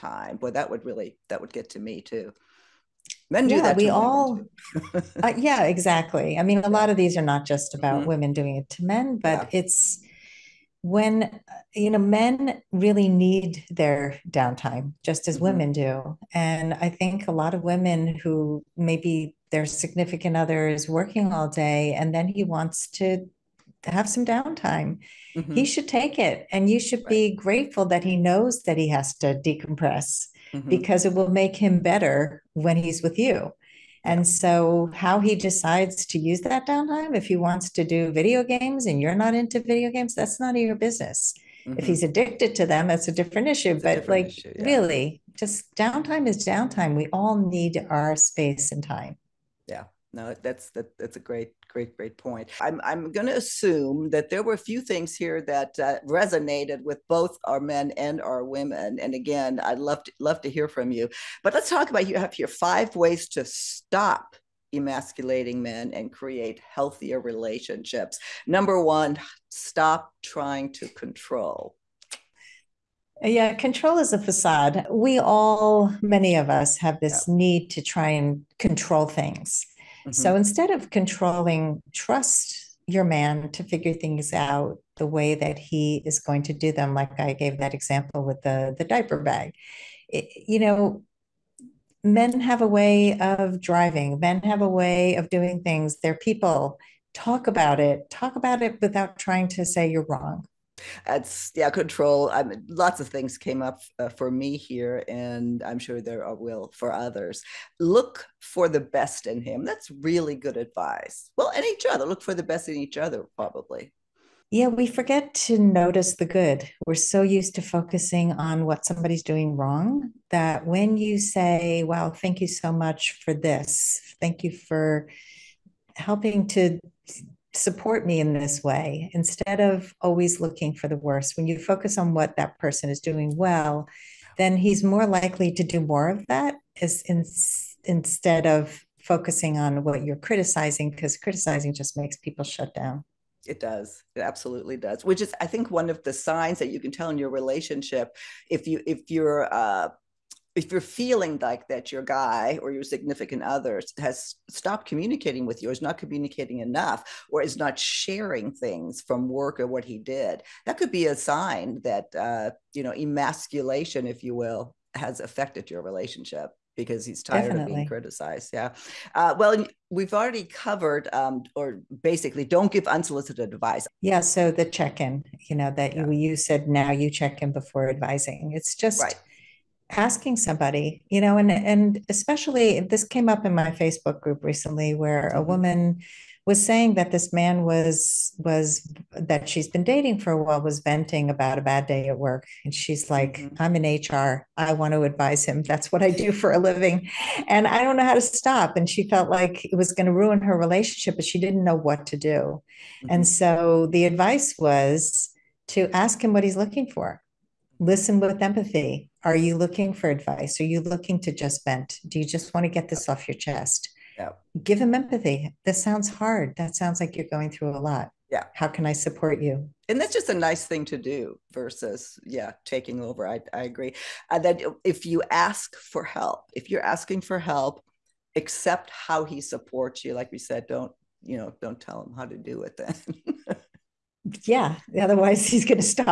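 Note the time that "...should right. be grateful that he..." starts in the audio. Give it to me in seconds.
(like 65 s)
26 s.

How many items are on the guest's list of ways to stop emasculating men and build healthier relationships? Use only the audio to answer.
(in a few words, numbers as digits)
5.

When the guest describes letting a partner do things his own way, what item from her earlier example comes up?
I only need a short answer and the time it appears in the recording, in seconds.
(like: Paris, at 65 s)
diaper bag, at 88 s.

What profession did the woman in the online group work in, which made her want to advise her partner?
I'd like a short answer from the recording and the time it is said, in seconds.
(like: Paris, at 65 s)
HR, at 194 s.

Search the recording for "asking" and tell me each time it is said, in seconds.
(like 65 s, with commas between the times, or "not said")
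179 s, 226 s.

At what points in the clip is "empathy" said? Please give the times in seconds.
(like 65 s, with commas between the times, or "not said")
208 s, 214 s.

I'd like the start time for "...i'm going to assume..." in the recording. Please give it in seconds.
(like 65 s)
52 s.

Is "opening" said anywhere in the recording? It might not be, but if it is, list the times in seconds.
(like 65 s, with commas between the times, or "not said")
not said.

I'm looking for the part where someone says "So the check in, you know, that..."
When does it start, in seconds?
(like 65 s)
174 s.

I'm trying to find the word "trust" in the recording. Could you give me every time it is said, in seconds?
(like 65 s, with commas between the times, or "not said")
81 s.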